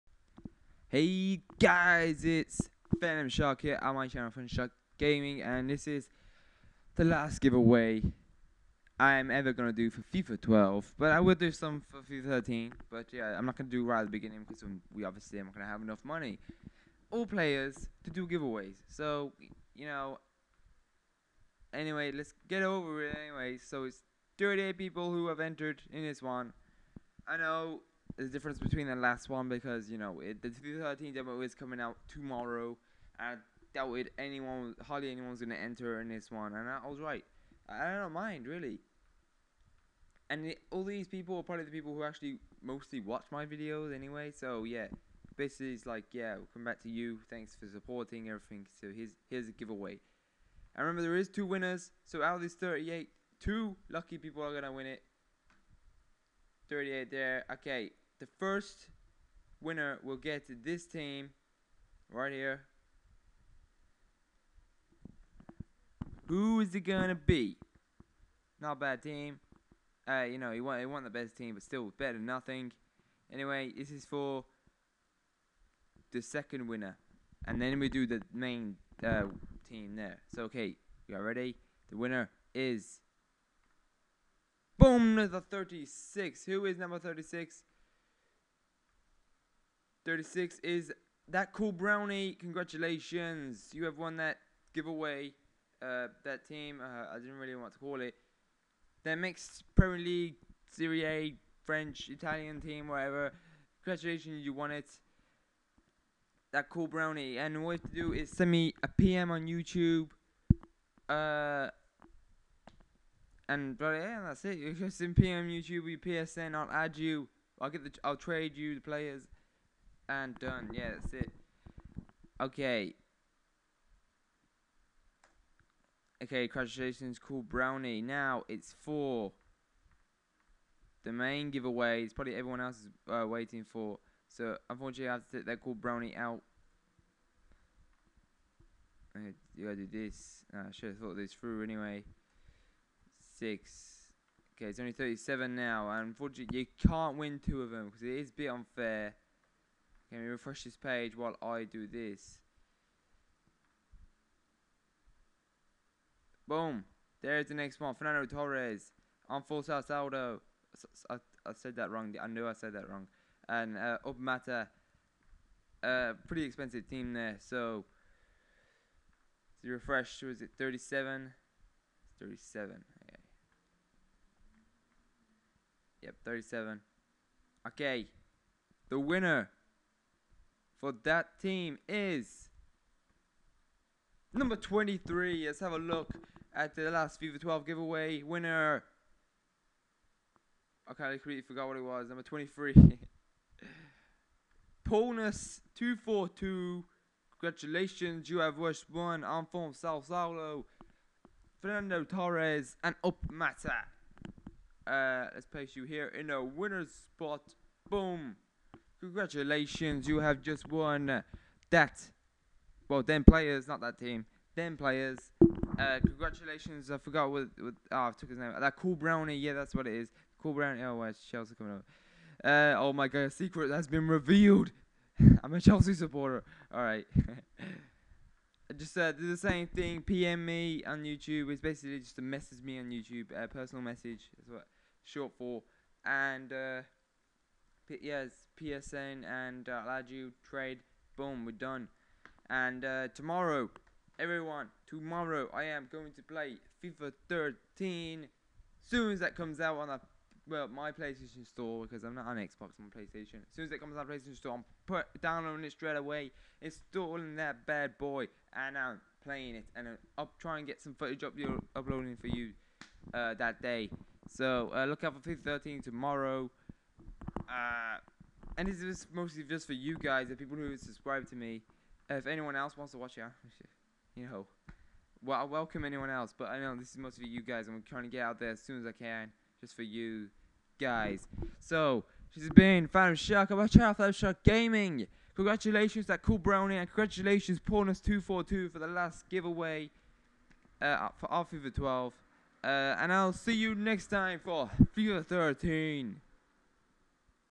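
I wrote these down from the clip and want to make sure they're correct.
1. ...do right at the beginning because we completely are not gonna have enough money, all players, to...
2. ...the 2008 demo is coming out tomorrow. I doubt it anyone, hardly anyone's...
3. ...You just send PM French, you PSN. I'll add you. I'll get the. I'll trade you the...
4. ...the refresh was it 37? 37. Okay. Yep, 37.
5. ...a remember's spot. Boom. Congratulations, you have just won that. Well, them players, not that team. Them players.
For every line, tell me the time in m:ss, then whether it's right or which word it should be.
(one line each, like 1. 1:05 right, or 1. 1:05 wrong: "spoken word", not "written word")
1. 0:13 wrong: "obviously", not "completely"
2. 0:30 wrong: "2013", not "2008"
3. 1:54 wrong: "YouTube", not "French"
4. 2:49 right
5. 3:26 wrong: "winner", not "remember".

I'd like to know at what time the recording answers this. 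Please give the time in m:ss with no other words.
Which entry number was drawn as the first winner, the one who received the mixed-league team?
1:24.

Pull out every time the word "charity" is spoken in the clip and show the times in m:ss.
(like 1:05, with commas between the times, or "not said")
not said.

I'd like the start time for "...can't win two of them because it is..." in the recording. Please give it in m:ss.
2:26.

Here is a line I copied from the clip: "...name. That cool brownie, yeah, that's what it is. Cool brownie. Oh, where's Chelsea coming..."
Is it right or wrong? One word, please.
right.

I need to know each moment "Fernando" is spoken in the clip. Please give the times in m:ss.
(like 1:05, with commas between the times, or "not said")
2:37, 3:21.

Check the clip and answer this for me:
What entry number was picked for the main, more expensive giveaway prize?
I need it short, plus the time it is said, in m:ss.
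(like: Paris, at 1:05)
23, at 3:04.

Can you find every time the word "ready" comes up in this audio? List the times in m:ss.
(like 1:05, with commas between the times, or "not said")
1:21.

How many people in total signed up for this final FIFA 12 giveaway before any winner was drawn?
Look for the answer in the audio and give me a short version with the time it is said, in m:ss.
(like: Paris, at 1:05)
38, at 0:24.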